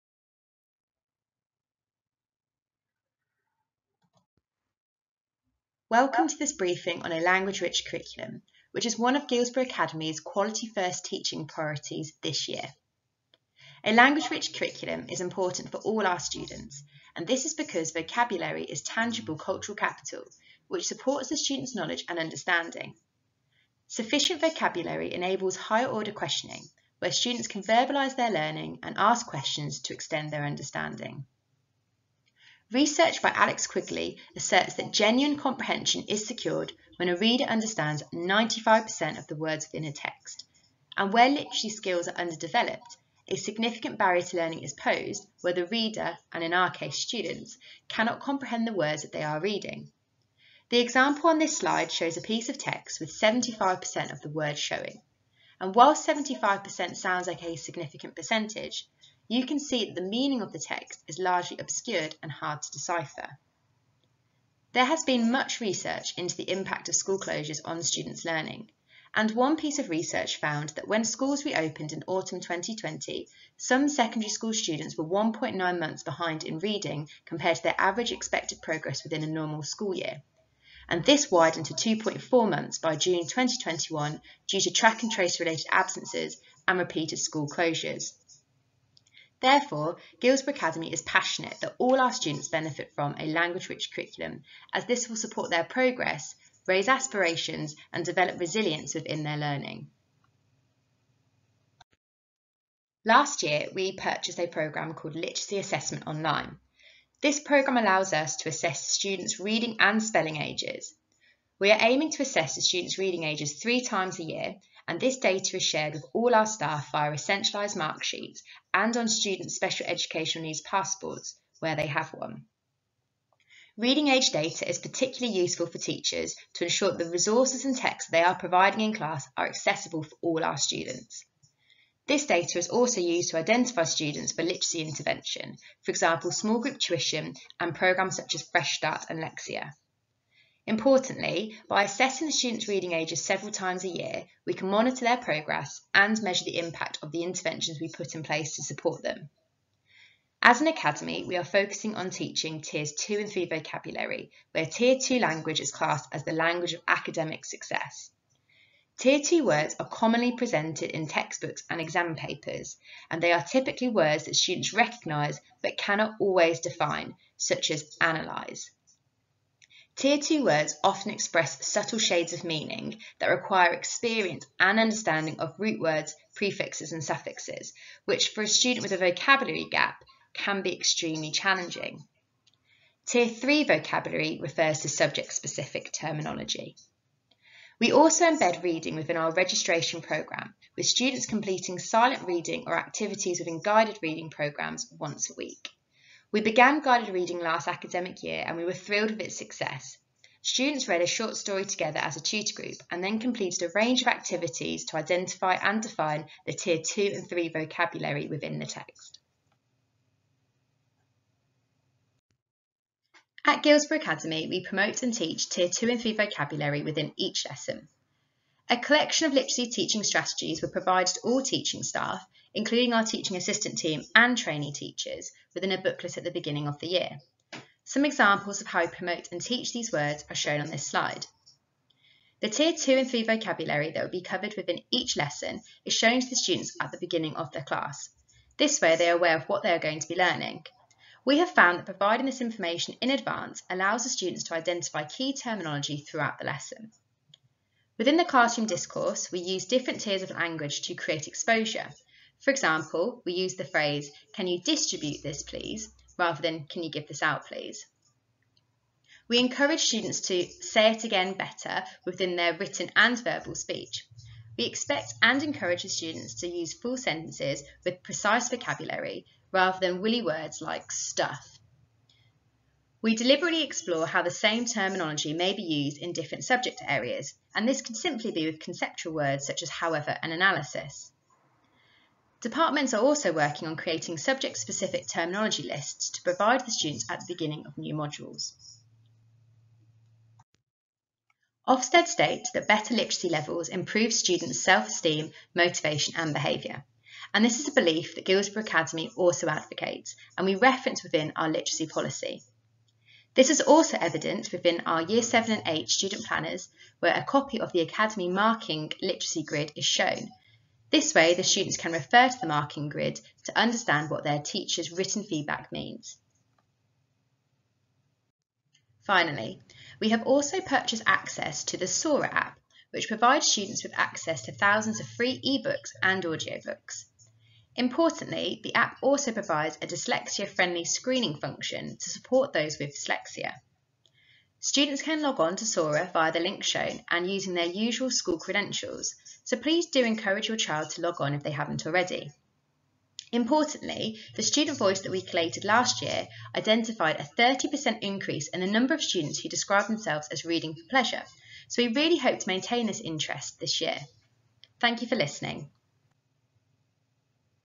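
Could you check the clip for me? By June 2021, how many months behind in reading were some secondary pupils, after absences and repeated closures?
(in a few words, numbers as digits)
2.4 months.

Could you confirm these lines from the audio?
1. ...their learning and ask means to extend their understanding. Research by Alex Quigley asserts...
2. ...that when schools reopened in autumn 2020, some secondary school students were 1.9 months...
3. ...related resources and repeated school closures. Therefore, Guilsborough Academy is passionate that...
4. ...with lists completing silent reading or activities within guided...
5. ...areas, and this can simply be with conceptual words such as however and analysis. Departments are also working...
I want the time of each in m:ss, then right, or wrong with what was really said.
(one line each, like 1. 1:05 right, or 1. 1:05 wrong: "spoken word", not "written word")
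1. 0:28 wrong: "questions", not "means"
2. 1:10 right
3. 1:25 wrong: "absences", not "resources"
4. 3:10 wrong: "students", not "lists"
5. 4:36 right.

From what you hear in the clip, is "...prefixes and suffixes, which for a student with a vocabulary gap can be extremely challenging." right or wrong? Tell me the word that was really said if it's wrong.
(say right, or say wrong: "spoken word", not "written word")
right.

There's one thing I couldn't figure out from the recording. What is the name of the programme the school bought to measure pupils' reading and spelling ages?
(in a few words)
Literacy Assessment Online.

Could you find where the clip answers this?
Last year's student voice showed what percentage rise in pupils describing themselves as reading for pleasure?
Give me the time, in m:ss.
5:47.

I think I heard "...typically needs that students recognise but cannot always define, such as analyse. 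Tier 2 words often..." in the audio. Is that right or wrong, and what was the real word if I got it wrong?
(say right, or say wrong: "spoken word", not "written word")
wrong: "words", not "needs".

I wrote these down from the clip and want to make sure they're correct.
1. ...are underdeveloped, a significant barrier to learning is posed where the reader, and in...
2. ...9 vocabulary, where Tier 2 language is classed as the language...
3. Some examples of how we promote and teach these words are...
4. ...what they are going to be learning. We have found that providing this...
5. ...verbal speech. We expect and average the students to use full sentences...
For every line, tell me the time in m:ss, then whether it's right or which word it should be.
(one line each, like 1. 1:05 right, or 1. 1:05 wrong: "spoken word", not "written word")
1. 0:42 right
2. 2:33 wrong: "3", not "9"
3. 3:47 right
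4. 3:59 right
5. 4:23 wrong: "encourage", not "average".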